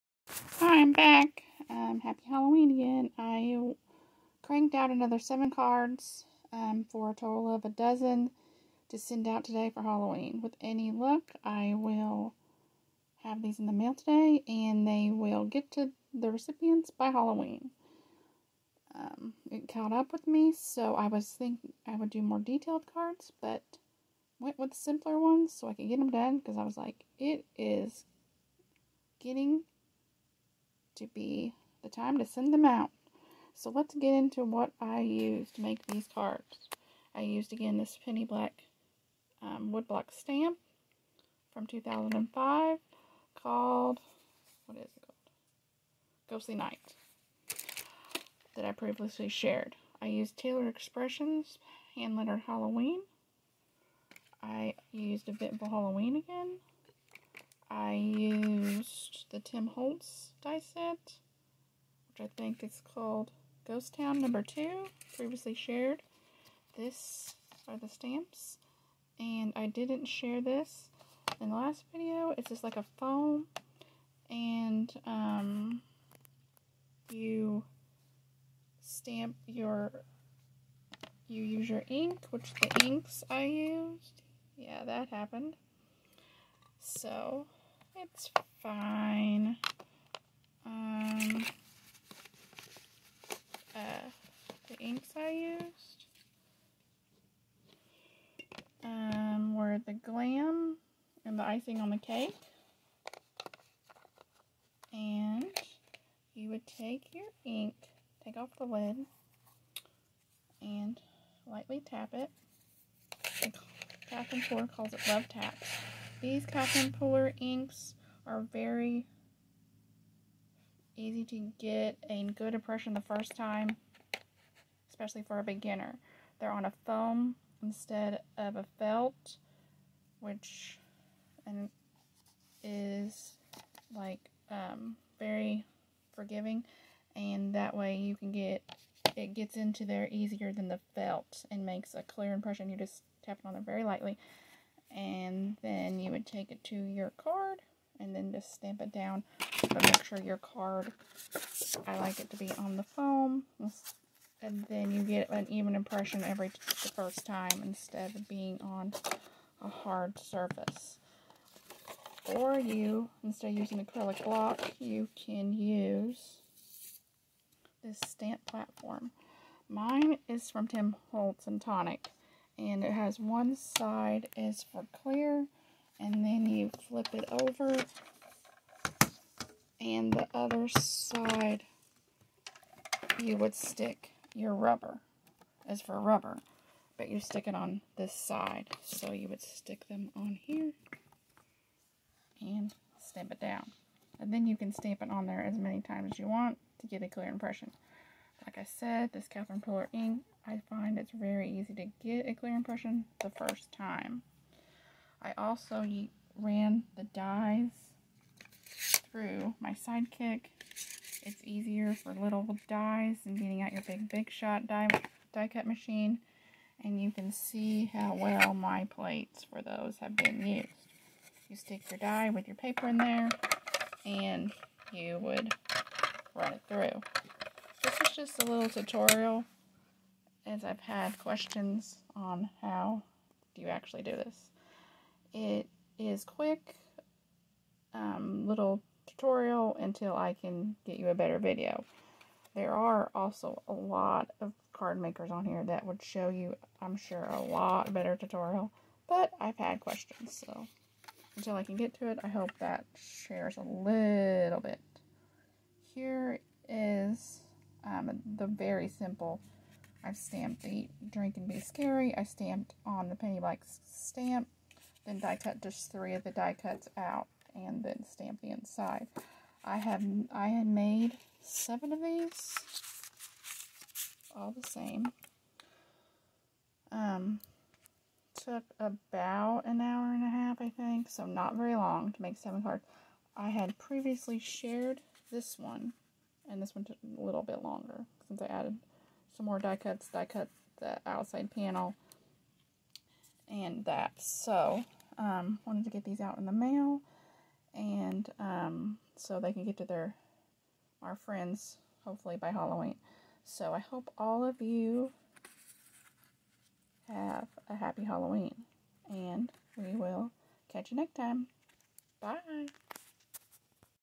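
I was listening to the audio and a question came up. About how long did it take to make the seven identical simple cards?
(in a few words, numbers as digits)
an hour and a half.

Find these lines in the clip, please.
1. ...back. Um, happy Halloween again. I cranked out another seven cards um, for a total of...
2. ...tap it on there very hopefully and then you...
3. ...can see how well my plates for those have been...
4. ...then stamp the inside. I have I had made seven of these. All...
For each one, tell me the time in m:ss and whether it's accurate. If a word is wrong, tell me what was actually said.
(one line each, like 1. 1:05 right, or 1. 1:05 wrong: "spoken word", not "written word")
1. 0:00 right
2. 2:23 wrong: "lightly", not "hopefully"
3. 3:37 right
4. 4:27 right.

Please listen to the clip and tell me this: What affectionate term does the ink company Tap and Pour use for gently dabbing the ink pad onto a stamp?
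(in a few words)
love taps.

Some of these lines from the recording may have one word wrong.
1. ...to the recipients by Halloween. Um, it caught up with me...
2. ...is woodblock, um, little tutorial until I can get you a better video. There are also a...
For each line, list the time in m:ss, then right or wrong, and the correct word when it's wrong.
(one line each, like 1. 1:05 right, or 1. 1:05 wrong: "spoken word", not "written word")
1. 0:15 right
2. 3:55 wrong: "quick", not "woodblock".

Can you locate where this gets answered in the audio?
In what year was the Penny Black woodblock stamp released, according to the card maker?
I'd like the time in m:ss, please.
0:41.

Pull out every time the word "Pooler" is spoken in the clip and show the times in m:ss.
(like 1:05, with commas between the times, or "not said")
1:57, 3:19.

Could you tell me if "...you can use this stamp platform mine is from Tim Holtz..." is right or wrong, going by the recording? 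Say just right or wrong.
right.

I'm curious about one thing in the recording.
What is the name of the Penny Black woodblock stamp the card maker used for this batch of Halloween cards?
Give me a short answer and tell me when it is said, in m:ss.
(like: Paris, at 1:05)
Ghostly Night, at 0:46.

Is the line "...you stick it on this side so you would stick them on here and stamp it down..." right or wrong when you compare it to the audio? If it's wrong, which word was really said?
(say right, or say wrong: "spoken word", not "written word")
right.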